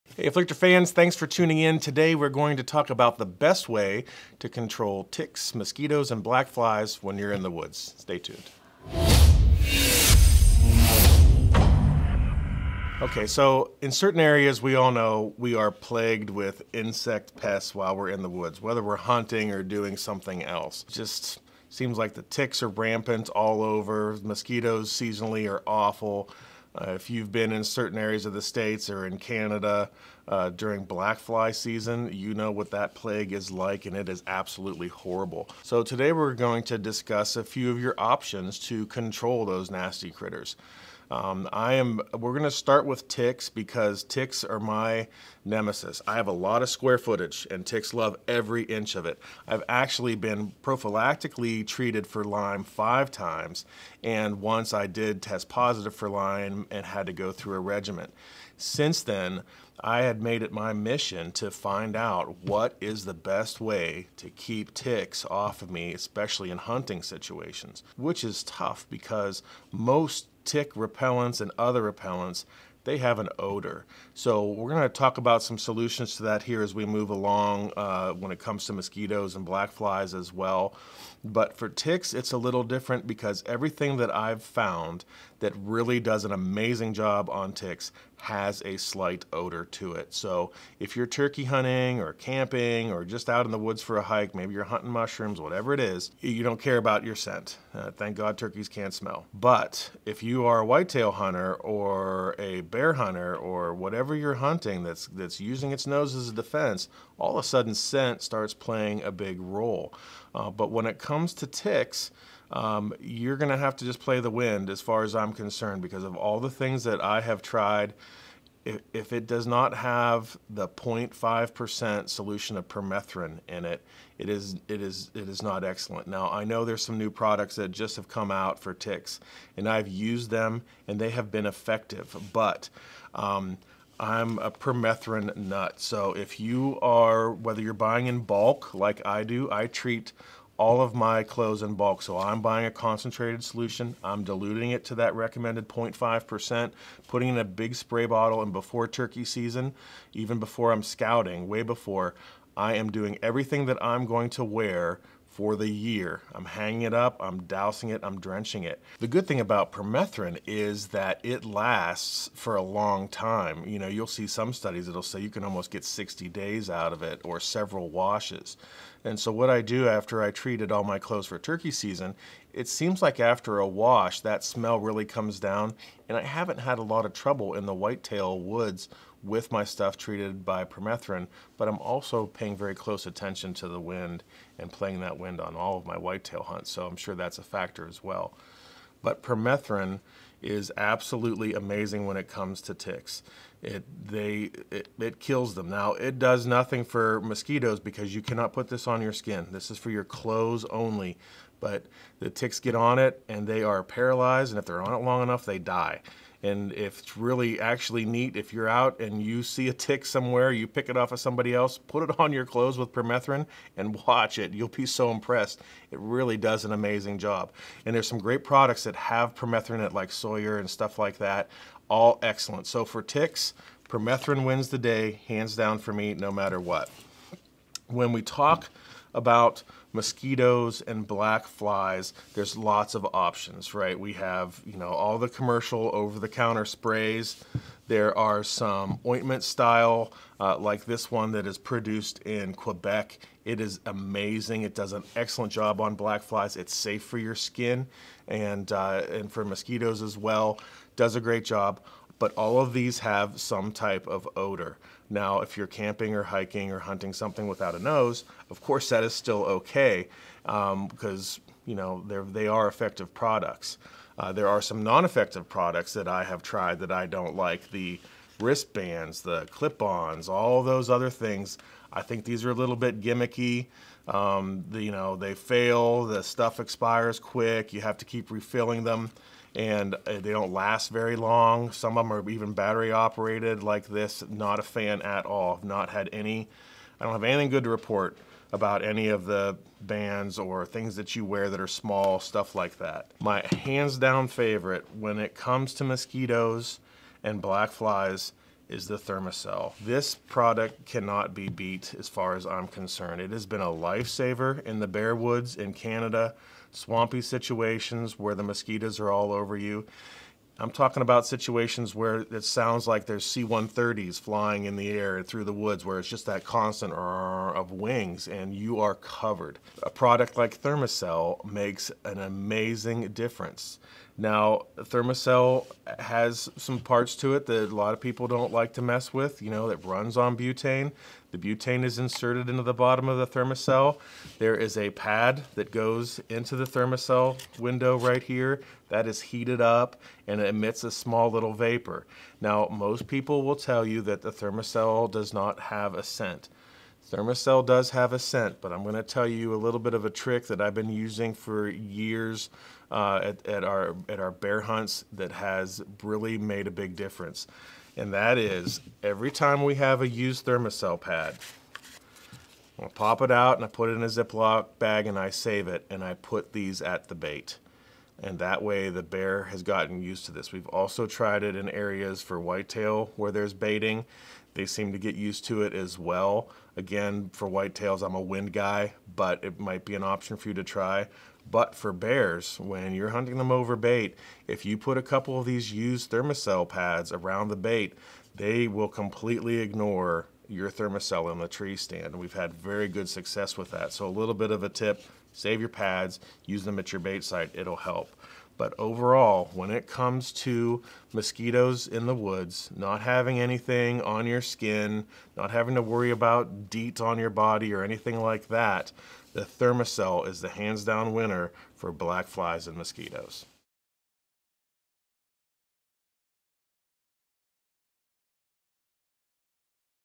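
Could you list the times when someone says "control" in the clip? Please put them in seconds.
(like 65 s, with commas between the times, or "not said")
4 s, 38 s.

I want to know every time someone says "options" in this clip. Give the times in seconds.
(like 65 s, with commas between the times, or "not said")
37 s, 233 s, 380 s.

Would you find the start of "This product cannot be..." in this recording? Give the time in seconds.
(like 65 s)
299 s.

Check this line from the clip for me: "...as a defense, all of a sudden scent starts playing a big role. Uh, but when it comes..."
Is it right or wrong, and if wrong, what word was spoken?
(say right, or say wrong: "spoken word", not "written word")
right.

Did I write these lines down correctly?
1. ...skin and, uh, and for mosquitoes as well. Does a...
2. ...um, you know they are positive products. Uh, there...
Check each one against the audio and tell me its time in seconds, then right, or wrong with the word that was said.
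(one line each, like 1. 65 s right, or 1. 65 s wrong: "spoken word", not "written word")
1. 247 s right
2. 261 s wrong: "effective", not "positive".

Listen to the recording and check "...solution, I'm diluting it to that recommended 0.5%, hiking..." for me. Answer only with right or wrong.
wrong.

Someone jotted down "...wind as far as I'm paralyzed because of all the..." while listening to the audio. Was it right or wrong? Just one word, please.
wrong.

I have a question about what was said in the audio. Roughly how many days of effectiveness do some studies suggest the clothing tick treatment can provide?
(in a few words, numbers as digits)
60 days.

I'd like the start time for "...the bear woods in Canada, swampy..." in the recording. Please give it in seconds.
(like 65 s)
304 s.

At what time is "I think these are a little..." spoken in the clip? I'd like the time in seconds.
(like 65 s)
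271 s.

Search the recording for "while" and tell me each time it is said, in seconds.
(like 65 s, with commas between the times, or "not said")
17 s.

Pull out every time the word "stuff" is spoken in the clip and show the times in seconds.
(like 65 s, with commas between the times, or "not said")
179 s, 220 s, 276 s, 292 s.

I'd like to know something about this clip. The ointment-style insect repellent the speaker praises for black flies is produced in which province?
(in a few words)
Quebec.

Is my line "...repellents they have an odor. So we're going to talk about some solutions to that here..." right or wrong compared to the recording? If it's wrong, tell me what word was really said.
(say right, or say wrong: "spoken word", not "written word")
right.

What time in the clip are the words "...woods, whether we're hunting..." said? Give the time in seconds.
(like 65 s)
18 s.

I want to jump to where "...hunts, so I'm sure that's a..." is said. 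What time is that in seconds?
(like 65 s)
186 s.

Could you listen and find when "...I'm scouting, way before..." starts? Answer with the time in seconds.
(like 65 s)
150 s.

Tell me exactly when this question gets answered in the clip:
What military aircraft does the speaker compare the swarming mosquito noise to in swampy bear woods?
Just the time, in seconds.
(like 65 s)
313 s.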